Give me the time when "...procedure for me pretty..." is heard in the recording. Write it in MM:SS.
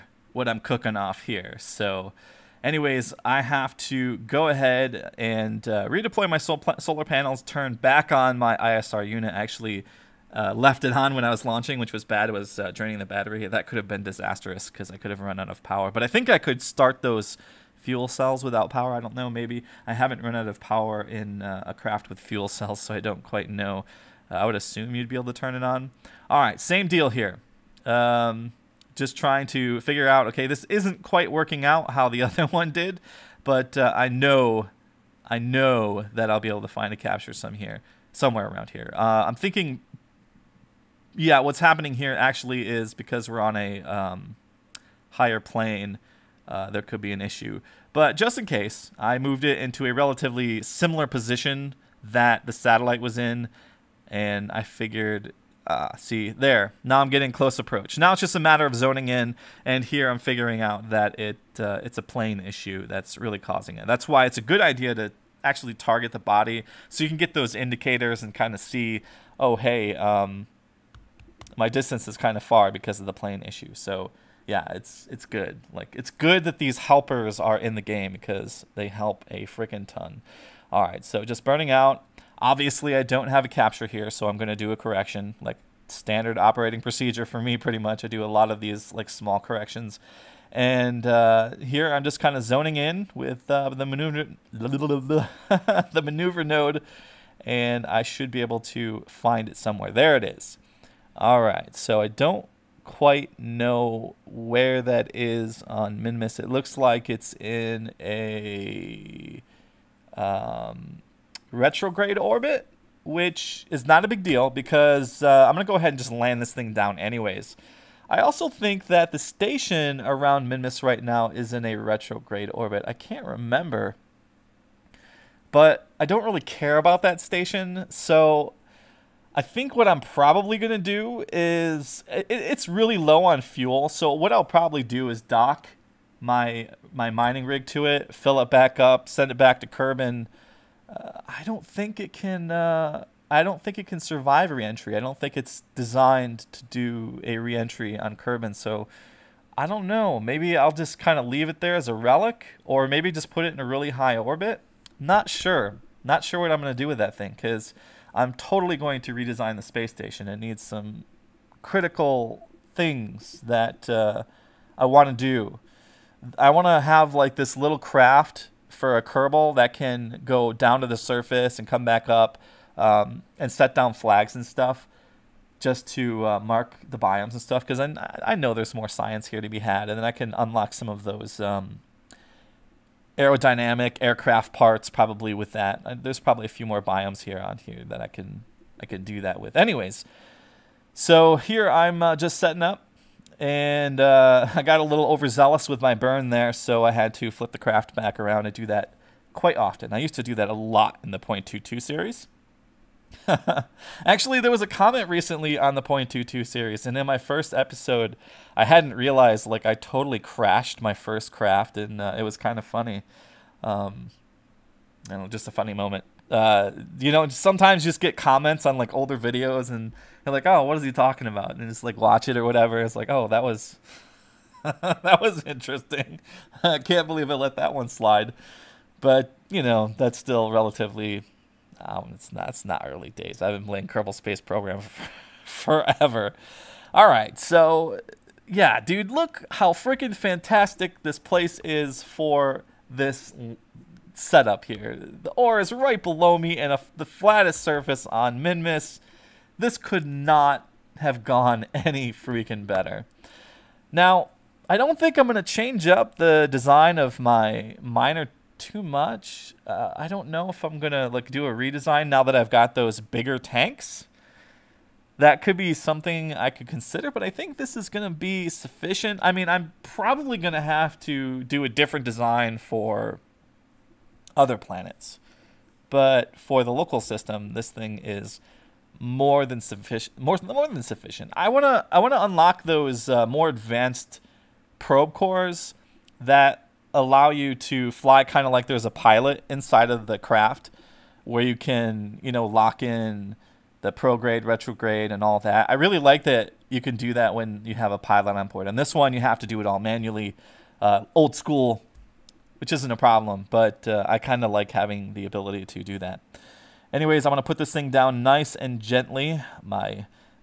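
01:26.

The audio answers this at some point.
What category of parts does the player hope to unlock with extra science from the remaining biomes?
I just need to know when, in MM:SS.
03:03.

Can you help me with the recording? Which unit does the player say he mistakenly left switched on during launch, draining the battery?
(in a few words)
ISR unit.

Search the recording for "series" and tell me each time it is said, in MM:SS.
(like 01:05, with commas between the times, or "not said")
03:21, 03:26.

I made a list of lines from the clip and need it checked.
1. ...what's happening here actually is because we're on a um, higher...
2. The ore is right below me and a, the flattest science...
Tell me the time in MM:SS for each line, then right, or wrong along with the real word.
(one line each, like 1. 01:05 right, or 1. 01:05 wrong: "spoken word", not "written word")
1. 00:41 right
2. 04:04 wrong: "surface", not "science".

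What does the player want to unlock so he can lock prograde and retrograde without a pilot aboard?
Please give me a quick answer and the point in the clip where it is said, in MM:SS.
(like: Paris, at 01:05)
More advanced probe cores, at 04:43.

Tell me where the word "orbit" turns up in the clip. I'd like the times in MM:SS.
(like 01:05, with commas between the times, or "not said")
01:52, 02:02, 02:34.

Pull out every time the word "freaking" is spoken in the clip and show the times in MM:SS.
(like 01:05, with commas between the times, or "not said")
01:19, 03:59, 04:12.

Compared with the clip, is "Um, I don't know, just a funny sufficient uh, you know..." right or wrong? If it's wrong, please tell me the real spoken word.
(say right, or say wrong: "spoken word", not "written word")
wrong: "moment", not "sufficient".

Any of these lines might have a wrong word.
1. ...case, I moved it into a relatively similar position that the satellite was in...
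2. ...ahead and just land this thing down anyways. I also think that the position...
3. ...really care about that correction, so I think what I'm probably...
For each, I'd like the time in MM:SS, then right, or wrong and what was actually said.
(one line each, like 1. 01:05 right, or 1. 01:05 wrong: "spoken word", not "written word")
1. 00:48 right
2. 01:55 wrong: "station", not "position"
3. 02:06 wrong: "station", not "correction".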